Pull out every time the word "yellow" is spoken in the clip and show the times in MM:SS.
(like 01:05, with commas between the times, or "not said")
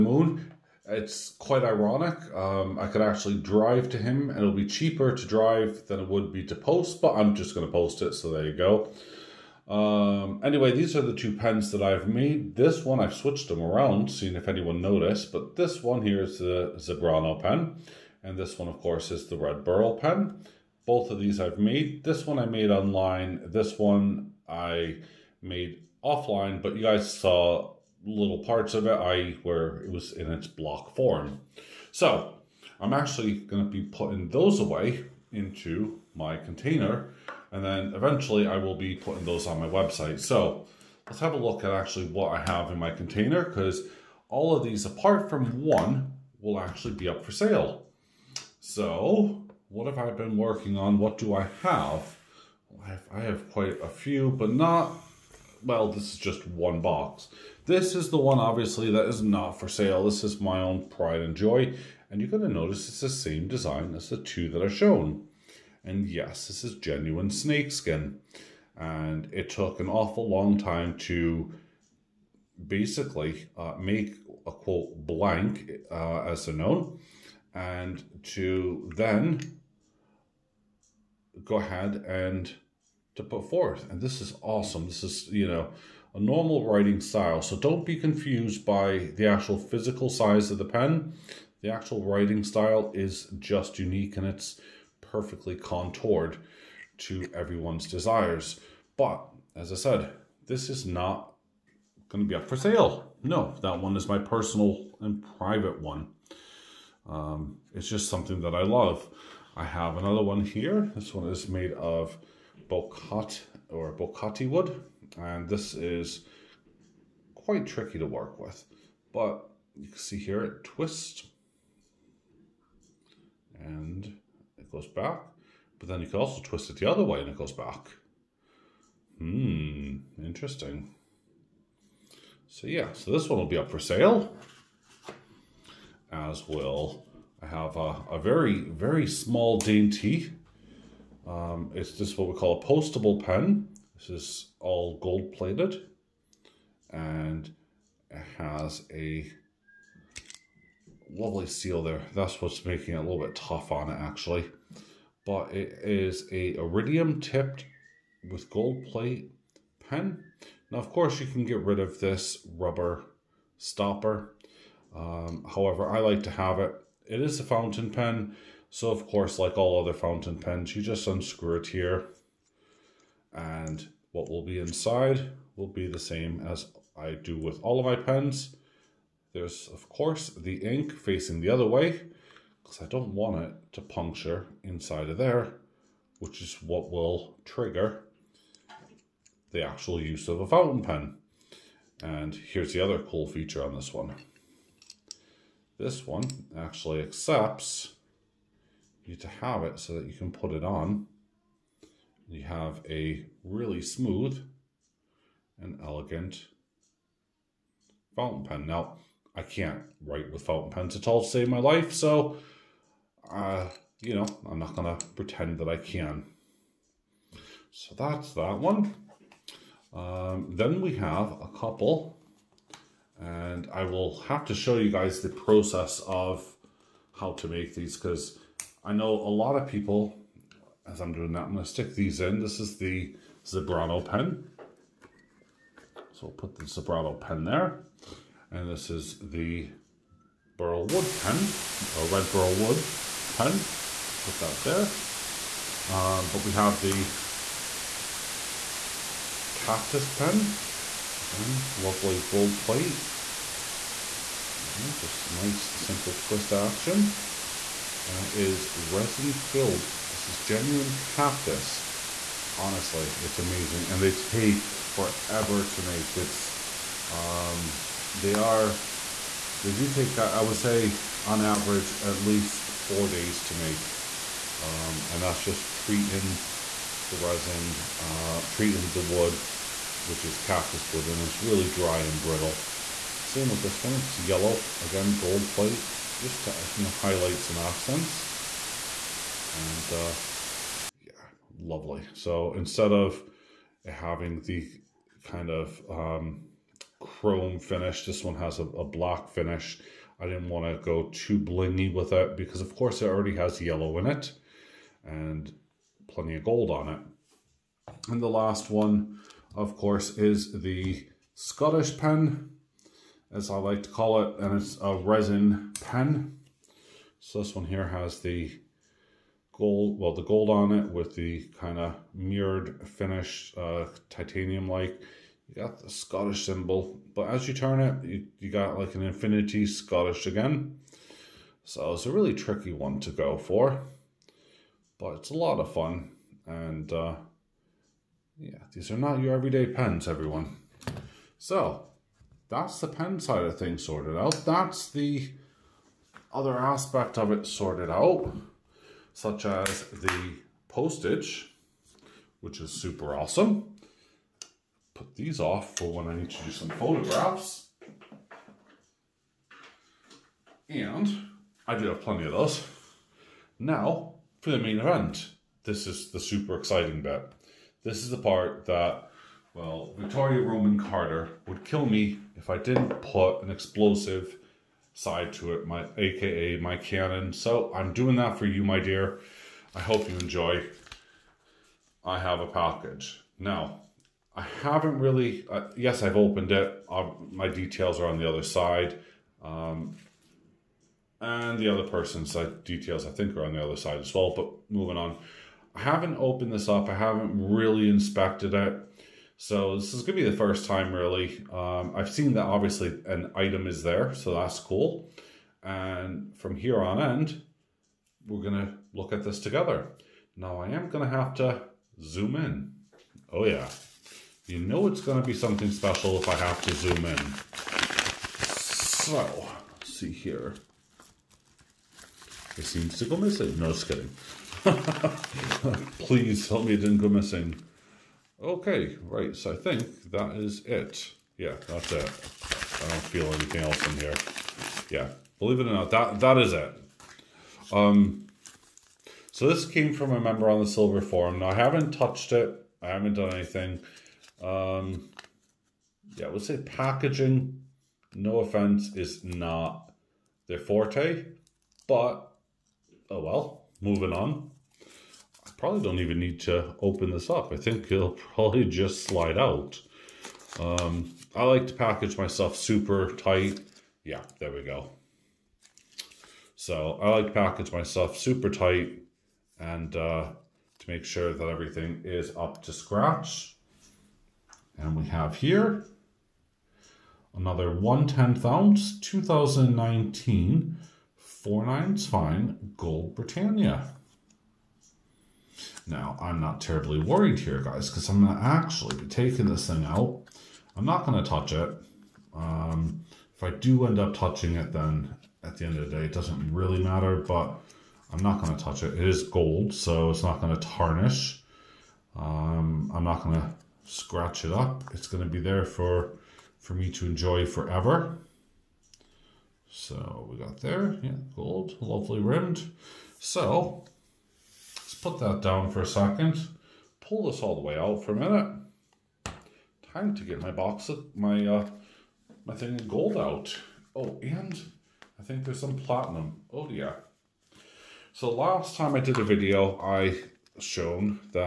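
04:44, 05:03.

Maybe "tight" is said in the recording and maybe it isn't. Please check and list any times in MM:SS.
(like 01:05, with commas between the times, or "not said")
07:43, 07:48.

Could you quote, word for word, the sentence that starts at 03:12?
And here's the other cool feature on this one.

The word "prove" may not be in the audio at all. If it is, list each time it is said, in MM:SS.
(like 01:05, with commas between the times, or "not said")
not said.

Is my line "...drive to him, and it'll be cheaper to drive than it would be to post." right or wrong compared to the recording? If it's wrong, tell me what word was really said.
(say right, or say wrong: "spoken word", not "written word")
right.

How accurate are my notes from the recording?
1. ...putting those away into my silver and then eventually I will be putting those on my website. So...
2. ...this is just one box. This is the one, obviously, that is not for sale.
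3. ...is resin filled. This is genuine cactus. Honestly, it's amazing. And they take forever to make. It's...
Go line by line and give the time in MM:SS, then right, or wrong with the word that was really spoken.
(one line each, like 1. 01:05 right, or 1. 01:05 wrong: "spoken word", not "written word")
1. 00:33 wrong: "container", not "silver"
2. 00:55 right
3. 04:18 right.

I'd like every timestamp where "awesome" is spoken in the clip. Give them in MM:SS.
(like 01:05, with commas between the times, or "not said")
01:24, 05:53.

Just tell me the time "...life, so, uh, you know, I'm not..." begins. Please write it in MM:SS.
03:31.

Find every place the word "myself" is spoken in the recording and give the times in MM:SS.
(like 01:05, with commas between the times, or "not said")
07:42, 07:47.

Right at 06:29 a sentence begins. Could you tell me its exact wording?
Um, and the other person's uh, details, I think, are on the other side as well.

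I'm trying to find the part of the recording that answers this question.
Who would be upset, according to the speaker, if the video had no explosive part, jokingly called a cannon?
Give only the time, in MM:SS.
06:09.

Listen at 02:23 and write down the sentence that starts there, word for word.
This is all gold plated and it has a lovely seal there.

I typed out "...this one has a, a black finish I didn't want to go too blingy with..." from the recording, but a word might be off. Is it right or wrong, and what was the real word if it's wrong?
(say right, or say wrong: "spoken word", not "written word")
right.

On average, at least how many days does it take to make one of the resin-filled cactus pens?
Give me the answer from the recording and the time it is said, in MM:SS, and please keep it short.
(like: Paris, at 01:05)
4 days, at 04:32.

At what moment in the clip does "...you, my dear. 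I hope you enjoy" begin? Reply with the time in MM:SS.
06:18.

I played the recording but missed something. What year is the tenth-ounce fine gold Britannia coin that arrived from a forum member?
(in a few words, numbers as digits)
2019.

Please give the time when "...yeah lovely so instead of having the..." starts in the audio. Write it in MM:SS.
04:51.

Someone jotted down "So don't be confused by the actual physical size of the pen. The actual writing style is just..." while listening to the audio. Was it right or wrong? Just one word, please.
right.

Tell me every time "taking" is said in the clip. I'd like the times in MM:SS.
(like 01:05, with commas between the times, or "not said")
08:09.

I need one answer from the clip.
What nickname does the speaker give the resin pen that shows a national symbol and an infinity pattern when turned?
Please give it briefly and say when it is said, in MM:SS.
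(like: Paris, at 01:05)
the Scottish pen, at 05:11.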